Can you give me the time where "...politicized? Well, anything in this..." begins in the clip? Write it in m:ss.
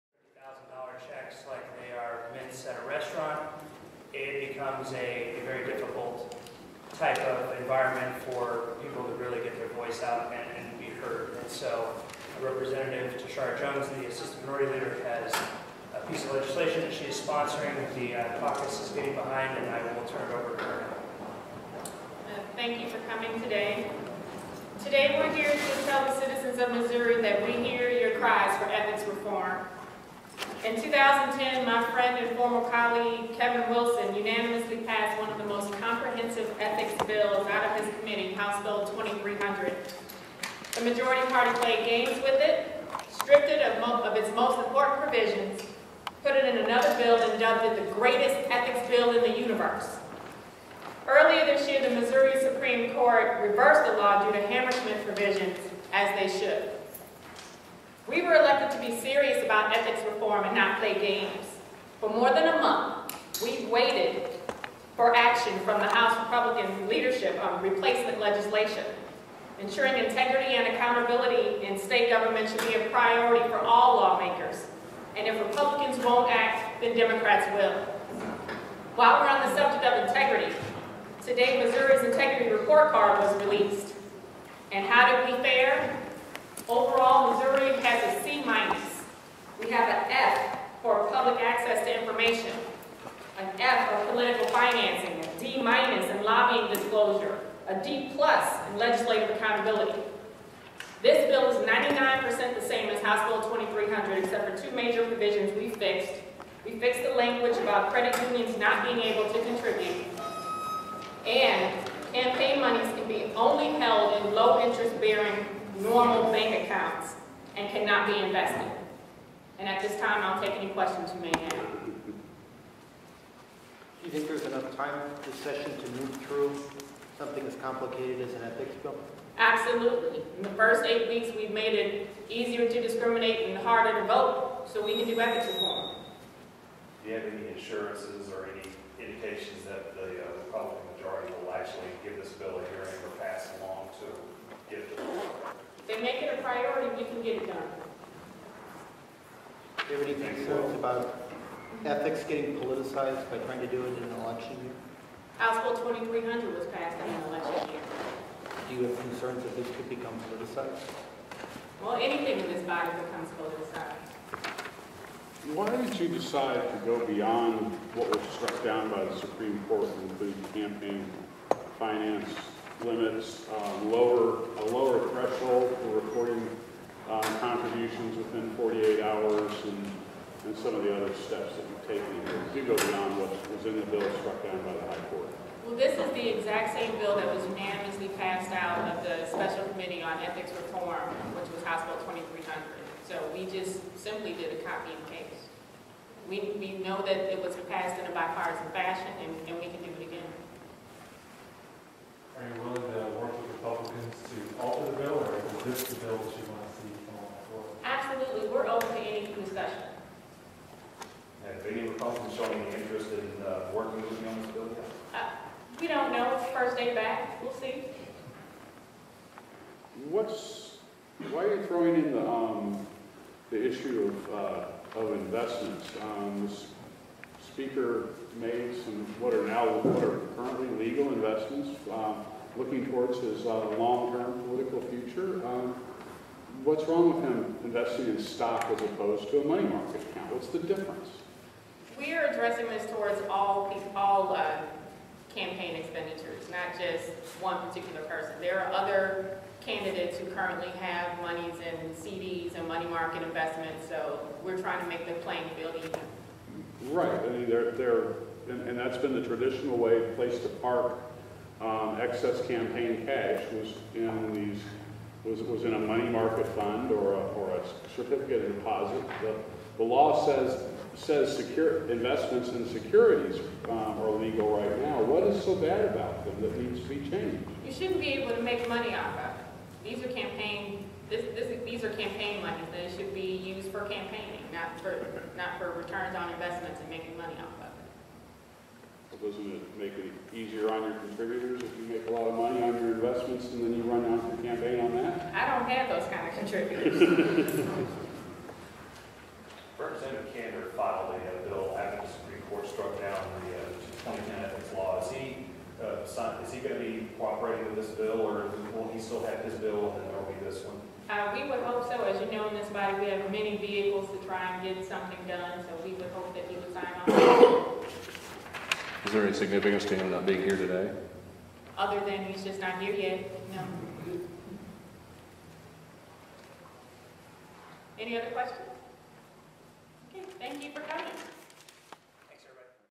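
2:40.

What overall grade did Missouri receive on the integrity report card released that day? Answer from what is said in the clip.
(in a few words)
C minus.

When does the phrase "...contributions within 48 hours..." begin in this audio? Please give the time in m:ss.
2:57.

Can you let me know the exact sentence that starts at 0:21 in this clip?
Uh, thank you for coming today.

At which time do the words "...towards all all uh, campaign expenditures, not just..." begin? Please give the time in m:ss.
4:02.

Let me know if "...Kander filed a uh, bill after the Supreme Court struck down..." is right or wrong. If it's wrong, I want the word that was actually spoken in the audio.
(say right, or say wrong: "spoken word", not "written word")
right.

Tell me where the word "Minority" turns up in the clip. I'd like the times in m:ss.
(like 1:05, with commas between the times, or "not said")
0:14.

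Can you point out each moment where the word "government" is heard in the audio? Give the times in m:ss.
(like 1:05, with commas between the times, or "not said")
1:12.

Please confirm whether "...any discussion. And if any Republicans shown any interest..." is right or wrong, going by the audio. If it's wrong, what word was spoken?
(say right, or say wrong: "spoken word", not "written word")
right.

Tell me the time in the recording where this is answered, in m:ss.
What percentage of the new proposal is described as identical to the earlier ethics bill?
1:41.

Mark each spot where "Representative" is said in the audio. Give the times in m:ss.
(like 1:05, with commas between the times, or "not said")
0:12, 4:59.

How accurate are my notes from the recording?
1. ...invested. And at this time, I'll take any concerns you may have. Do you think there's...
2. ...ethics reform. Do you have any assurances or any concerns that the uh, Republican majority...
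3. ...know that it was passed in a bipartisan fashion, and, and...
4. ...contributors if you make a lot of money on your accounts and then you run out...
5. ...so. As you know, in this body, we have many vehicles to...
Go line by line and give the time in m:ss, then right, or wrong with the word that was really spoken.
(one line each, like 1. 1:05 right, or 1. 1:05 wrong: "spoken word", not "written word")
1. 1:58 wrong: "questions", not "concerns"
2. 2:15 wrong: "indications", not "concerns"
3. 3:16 right
4. 4:50 wrong: "investments", not "accounts"
5. 5:11 right.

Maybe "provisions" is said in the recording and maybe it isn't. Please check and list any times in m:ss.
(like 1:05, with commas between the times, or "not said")
0:45, 0:55, 1:45.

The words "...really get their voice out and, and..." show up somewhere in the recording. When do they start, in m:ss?
0:09.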